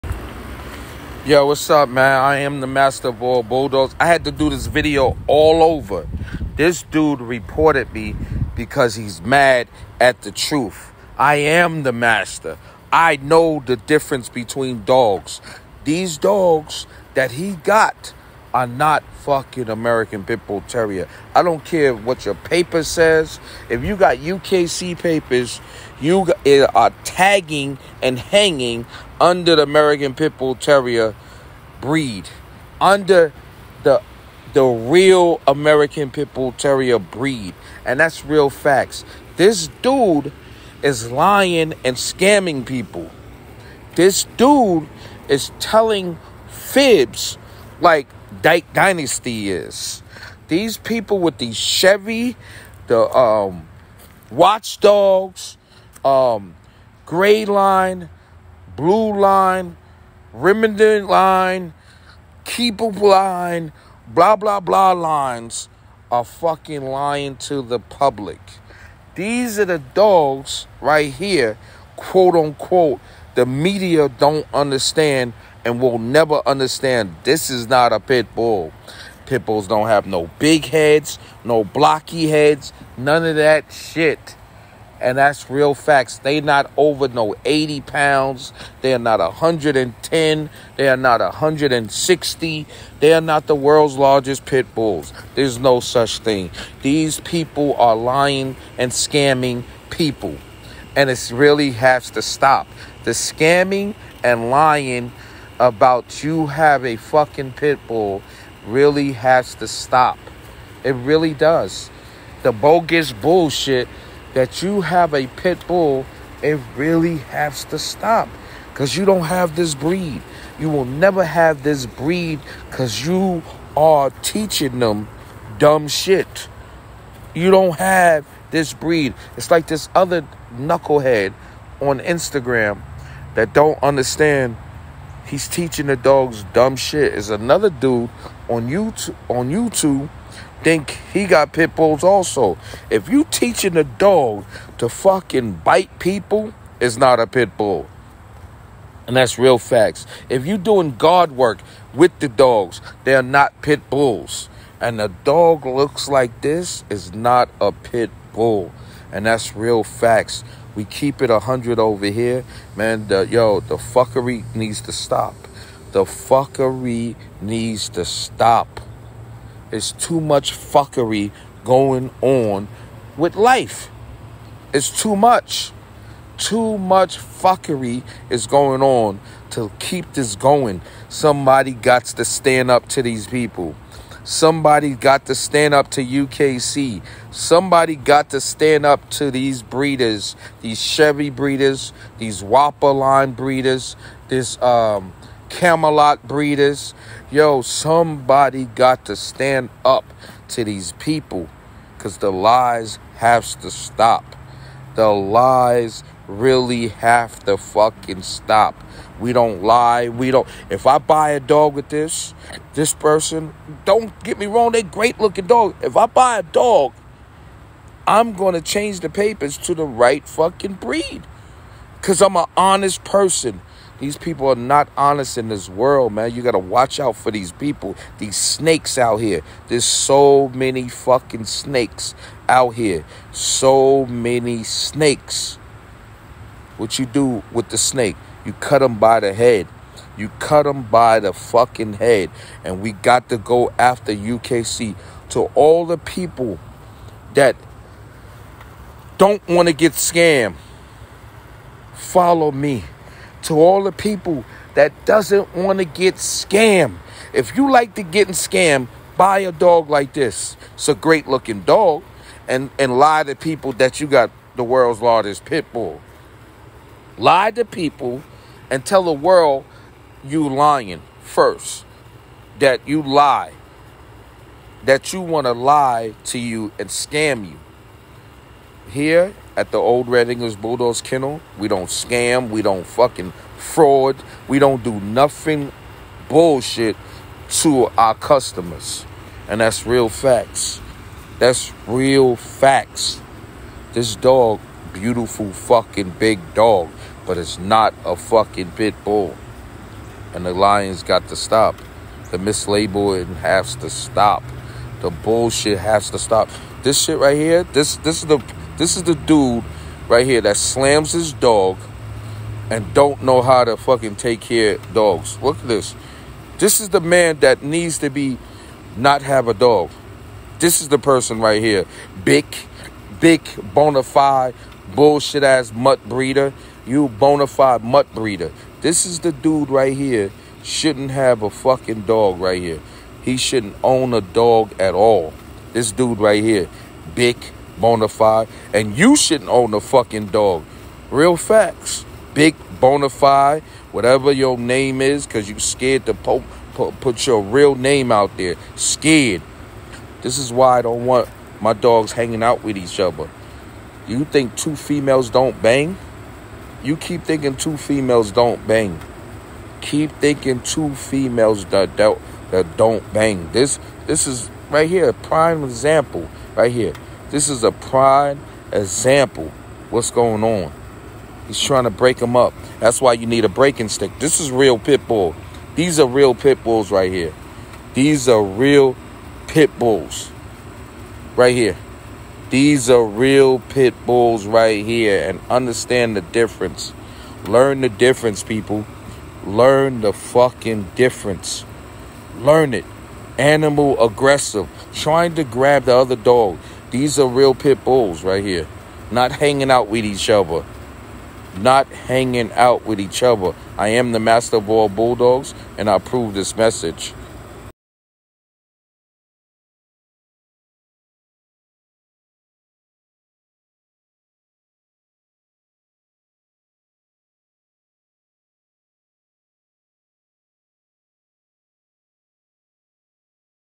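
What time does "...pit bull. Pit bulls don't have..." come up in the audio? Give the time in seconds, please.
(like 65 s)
77 s.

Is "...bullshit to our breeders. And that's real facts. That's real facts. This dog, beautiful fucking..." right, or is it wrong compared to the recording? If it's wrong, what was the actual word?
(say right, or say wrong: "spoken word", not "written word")
wrong: "customers", not "breeders".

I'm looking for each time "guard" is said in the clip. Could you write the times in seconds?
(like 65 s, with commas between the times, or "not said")
150 s.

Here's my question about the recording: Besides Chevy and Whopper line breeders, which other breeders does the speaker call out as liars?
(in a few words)
Camelot.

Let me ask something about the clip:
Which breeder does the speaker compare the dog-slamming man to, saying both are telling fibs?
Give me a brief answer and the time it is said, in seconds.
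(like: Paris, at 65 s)
Dark Dynasty, at 48 s.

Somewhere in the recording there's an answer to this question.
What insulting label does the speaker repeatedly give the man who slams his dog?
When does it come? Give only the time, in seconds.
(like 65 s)
327 s.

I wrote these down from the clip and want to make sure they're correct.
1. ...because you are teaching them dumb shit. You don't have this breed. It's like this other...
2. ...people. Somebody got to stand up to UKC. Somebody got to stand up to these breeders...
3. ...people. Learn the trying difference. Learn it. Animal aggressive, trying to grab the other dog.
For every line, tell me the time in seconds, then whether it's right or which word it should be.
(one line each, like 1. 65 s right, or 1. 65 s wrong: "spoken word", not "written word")
1. 122 s right
2. 183 s right
3. 388 s wrong: "fucking", not "trying".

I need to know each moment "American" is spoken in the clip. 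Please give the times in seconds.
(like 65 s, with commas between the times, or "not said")
19 s, 29 s, 35 s.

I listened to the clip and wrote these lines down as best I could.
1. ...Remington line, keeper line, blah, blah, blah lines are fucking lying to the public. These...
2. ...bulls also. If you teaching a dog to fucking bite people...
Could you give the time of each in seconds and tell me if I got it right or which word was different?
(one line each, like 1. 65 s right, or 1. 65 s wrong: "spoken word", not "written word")
1. 60 s right
2. 141 s right.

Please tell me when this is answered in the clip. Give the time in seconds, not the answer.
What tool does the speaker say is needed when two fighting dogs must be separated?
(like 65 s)
373 s.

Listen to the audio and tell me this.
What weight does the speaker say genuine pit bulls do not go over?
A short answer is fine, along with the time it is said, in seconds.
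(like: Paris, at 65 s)
80 pounds, at 87 s.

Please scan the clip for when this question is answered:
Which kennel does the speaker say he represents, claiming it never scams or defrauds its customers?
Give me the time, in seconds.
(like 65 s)
279 s.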